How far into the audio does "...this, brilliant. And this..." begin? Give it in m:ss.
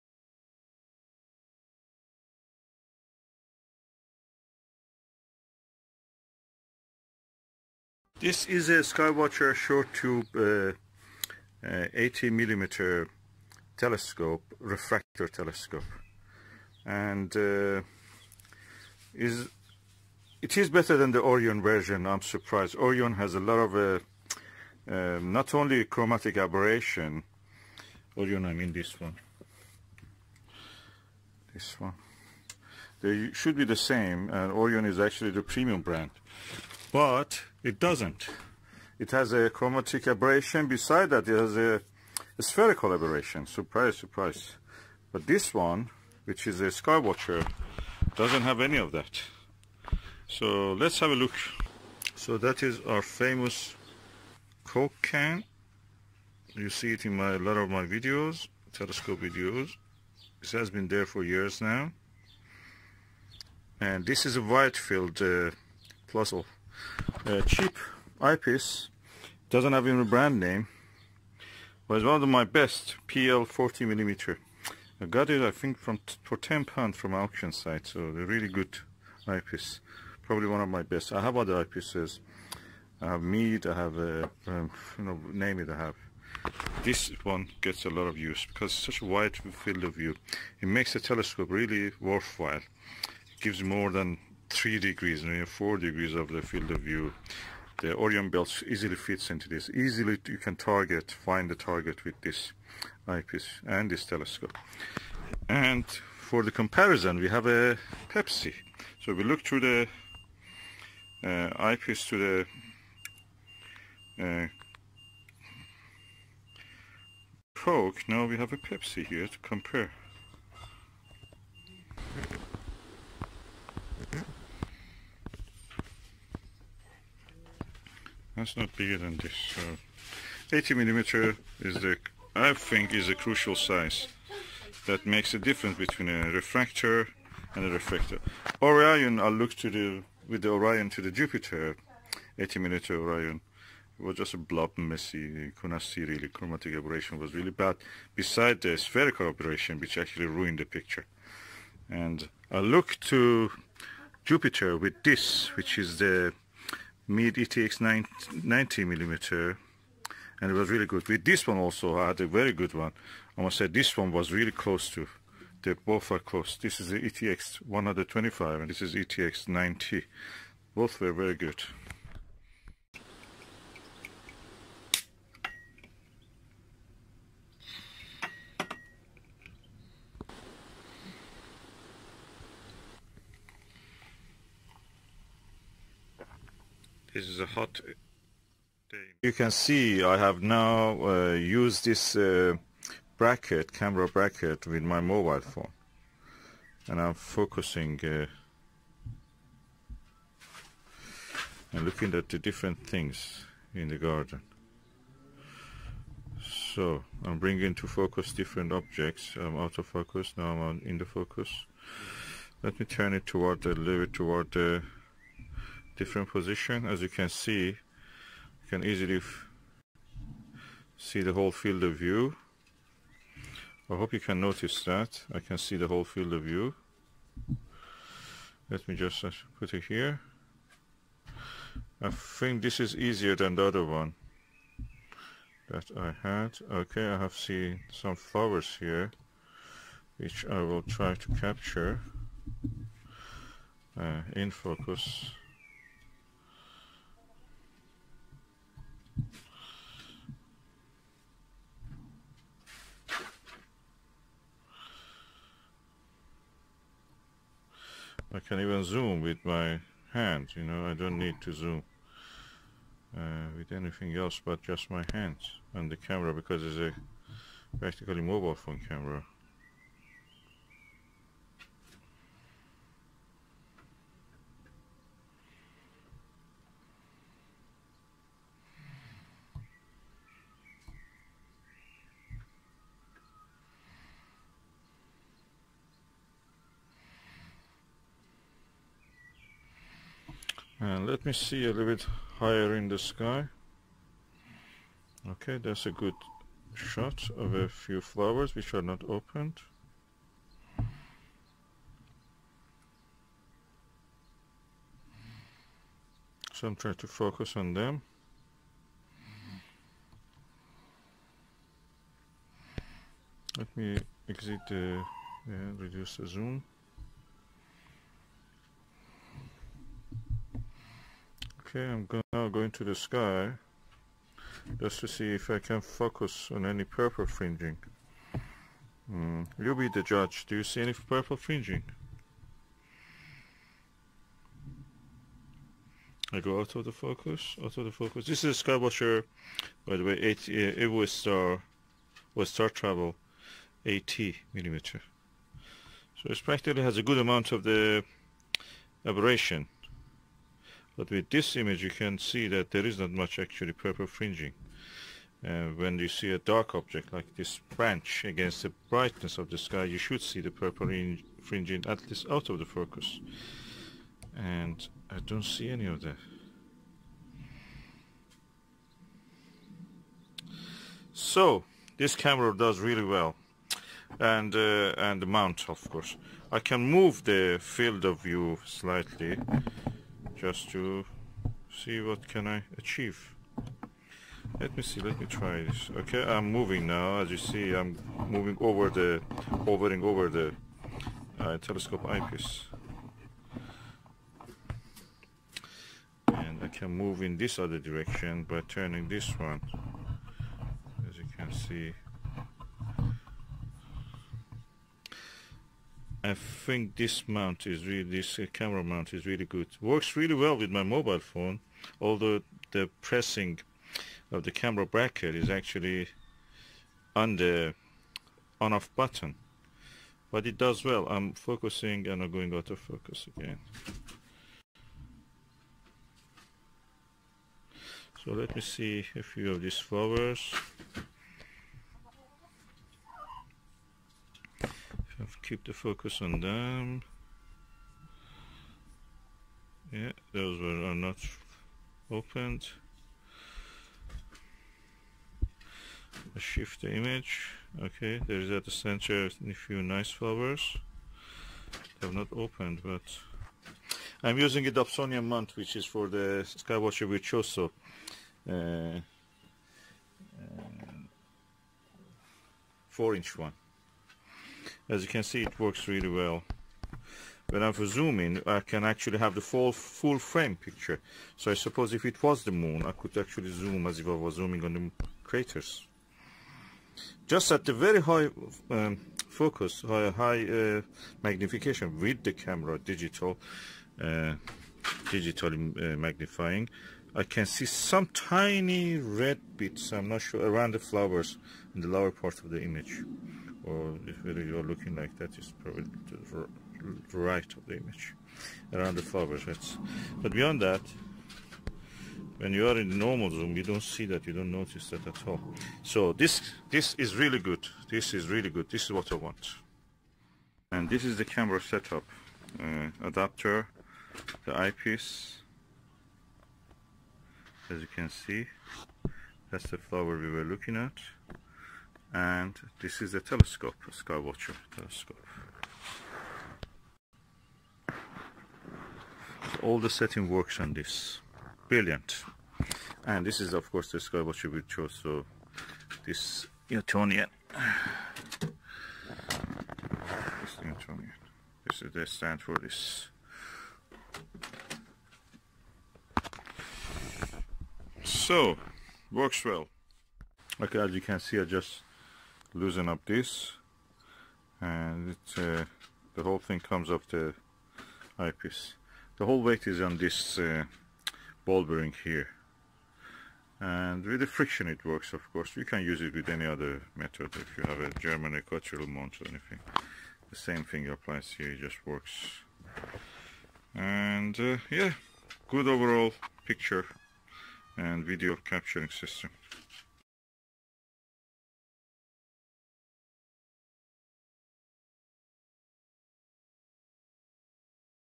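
8:50.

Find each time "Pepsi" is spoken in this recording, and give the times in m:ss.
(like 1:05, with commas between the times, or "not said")
1:48, 1:58.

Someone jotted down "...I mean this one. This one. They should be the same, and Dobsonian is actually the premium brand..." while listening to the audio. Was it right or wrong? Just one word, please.
wrong.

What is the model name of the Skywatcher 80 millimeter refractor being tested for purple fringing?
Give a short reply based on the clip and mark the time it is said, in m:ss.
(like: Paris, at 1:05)
Star Travel, at 5:42.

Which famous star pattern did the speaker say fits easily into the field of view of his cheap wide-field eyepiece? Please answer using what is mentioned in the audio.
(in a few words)
Orion belt.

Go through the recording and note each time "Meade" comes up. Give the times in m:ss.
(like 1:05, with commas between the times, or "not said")
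1:23, 2:37.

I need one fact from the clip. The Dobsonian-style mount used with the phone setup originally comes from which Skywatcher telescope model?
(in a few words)
Virtuoso.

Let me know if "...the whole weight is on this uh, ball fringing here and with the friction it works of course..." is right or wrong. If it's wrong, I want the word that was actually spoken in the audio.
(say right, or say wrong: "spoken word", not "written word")
wrong: "bearing", not "fringing".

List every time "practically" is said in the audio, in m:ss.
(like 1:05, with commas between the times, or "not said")
4:27, 5:46.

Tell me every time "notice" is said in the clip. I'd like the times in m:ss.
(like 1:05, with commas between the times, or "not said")
3:44, 8:24.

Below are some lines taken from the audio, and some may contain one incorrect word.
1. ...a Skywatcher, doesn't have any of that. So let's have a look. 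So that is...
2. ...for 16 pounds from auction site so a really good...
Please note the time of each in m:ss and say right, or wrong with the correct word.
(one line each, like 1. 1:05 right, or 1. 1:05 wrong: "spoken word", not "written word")
1. 0:46 right
2. 1:16 wrong: "10", not "16".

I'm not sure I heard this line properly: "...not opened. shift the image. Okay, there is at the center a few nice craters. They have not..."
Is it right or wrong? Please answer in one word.
wrong.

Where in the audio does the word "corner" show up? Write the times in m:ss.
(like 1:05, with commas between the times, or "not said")
not said.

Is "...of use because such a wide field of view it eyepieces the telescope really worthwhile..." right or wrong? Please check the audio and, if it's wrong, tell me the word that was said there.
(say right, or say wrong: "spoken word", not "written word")
wrong: "makes", not "eyepieces".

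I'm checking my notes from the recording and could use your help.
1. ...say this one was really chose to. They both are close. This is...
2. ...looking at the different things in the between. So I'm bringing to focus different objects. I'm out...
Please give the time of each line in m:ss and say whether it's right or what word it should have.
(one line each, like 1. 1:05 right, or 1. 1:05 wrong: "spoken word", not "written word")
1. 2:43 wrong: "close", not "chose"
2. 3:21 wrong: "garden", not "between".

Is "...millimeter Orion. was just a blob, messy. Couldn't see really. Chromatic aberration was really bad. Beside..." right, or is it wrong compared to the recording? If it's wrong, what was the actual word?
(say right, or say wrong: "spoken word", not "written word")
right.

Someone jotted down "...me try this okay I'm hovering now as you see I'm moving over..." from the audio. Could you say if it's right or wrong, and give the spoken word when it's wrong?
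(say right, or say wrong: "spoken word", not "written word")
wrong: "moving", not "hovering".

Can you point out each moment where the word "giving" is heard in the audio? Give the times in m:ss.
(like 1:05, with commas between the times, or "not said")
not said.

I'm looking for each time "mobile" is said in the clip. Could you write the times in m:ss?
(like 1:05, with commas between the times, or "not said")
3:15, 4:28, 6:50.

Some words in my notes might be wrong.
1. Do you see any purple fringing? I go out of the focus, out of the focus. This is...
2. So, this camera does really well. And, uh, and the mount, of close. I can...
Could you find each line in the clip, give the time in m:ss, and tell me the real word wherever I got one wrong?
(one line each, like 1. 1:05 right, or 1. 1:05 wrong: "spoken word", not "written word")
1. 5:30 right
2. 6:11 wrong: "course", not "close".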